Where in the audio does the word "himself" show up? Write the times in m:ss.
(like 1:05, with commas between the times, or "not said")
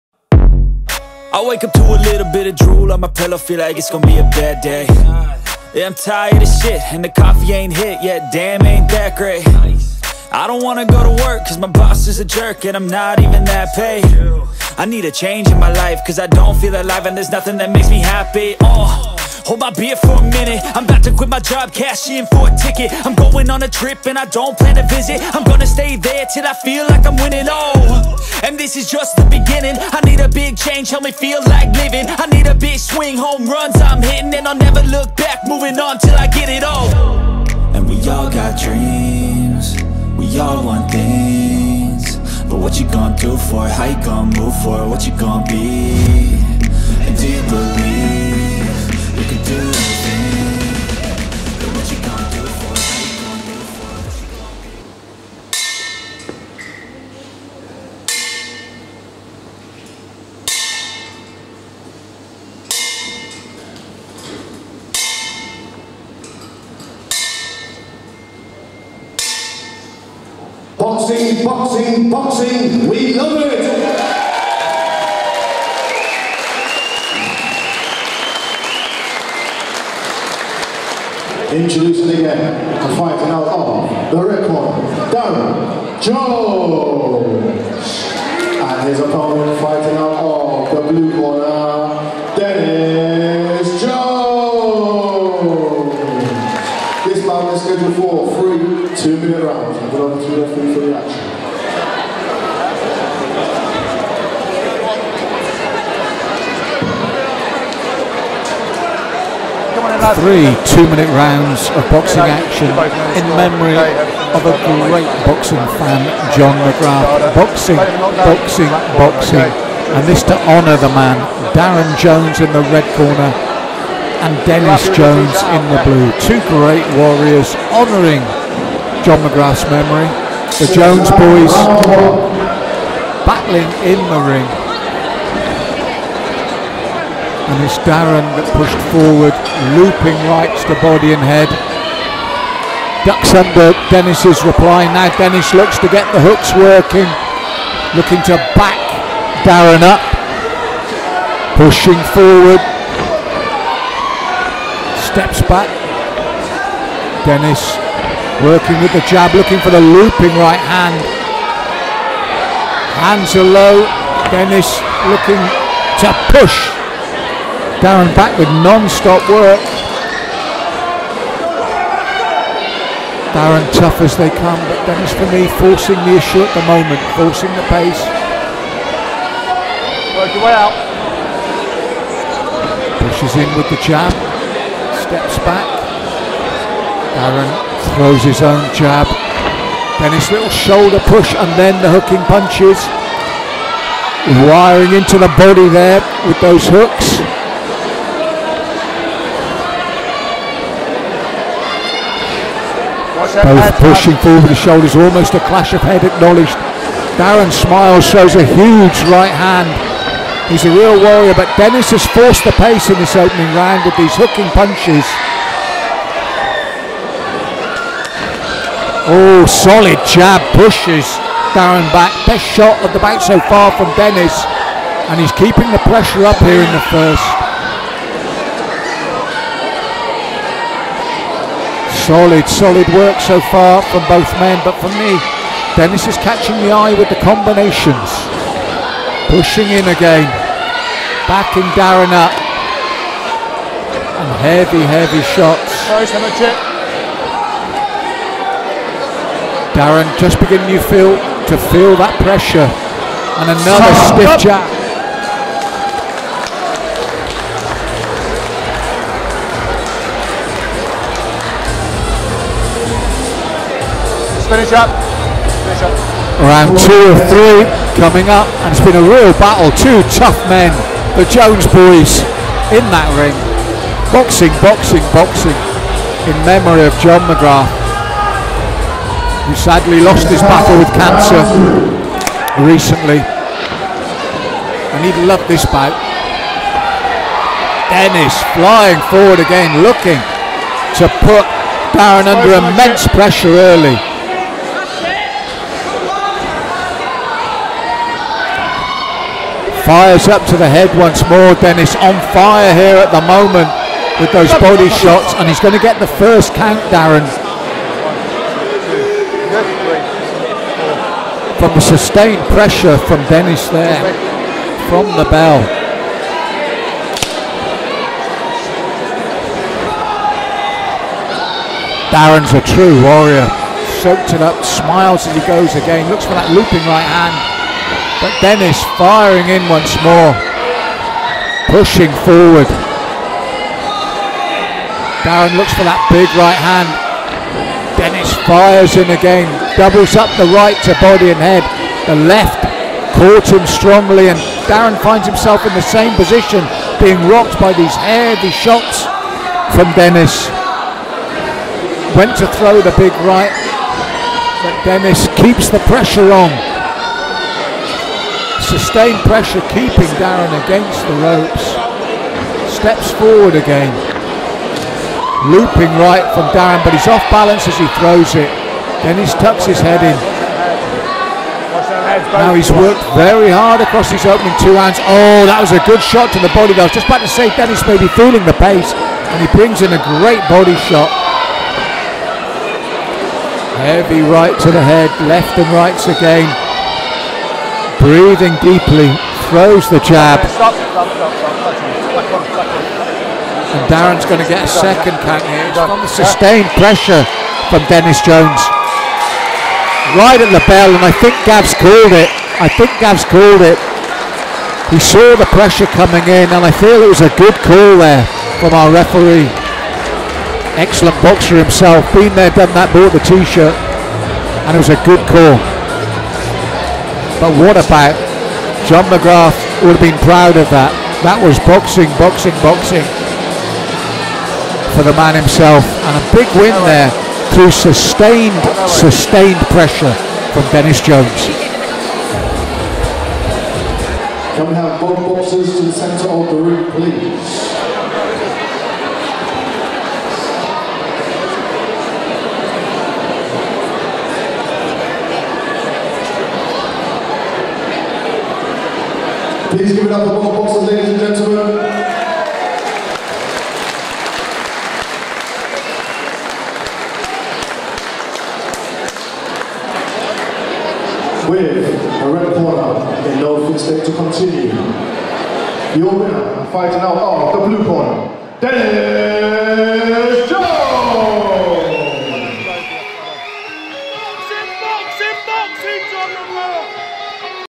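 5:45, 6:51, 7:05.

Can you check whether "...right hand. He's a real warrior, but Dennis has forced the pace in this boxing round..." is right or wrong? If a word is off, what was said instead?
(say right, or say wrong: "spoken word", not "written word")
wrong: "opening", not "boxing".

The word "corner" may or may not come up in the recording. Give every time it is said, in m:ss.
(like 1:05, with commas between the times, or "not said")
2:02, 7:42, 7:47.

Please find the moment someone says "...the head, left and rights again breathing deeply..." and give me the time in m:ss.
6:24.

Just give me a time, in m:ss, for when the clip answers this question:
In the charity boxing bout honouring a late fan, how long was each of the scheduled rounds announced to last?
1:50.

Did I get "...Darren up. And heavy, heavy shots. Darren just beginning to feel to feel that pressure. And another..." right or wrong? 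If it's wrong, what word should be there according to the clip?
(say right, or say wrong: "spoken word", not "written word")
right.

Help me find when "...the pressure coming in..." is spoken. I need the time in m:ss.
6:45.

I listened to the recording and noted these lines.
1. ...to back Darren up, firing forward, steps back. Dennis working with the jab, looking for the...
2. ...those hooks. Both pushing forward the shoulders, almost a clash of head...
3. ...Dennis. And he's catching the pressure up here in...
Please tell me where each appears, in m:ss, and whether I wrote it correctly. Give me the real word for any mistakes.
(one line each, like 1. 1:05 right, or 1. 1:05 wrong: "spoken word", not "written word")
1. 2:28 wrong: "pushing", not "firing"
2. 3:16 right
3. 3:43 wrong: "keeping", not "catching".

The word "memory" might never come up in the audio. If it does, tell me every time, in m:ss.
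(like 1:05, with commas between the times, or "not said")
1:53, 2:09, 4:36.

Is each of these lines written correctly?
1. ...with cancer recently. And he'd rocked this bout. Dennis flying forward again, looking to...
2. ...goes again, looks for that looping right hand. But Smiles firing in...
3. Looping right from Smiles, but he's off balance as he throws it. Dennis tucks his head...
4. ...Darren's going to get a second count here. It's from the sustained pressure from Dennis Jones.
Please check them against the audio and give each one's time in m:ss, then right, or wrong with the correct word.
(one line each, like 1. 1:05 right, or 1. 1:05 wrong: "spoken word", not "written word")
1. 4:40 wrong: "loved", not "rocked"
2. 5:25 wrong: "Dennis", not "Smiles"
3. 6:05 wrong: "Darren", not "Smiles"
4. 6:33 right.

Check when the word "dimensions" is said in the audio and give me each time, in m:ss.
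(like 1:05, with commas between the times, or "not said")
not said.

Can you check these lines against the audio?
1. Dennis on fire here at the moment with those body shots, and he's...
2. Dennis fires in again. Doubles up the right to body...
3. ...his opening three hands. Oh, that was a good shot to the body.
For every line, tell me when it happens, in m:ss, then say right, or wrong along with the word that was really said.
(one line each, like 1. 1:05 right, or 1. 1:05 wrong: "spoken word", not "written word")
1. 5:01 right
2. 5:37 right
3. 6:14 wrong: "two", not "three".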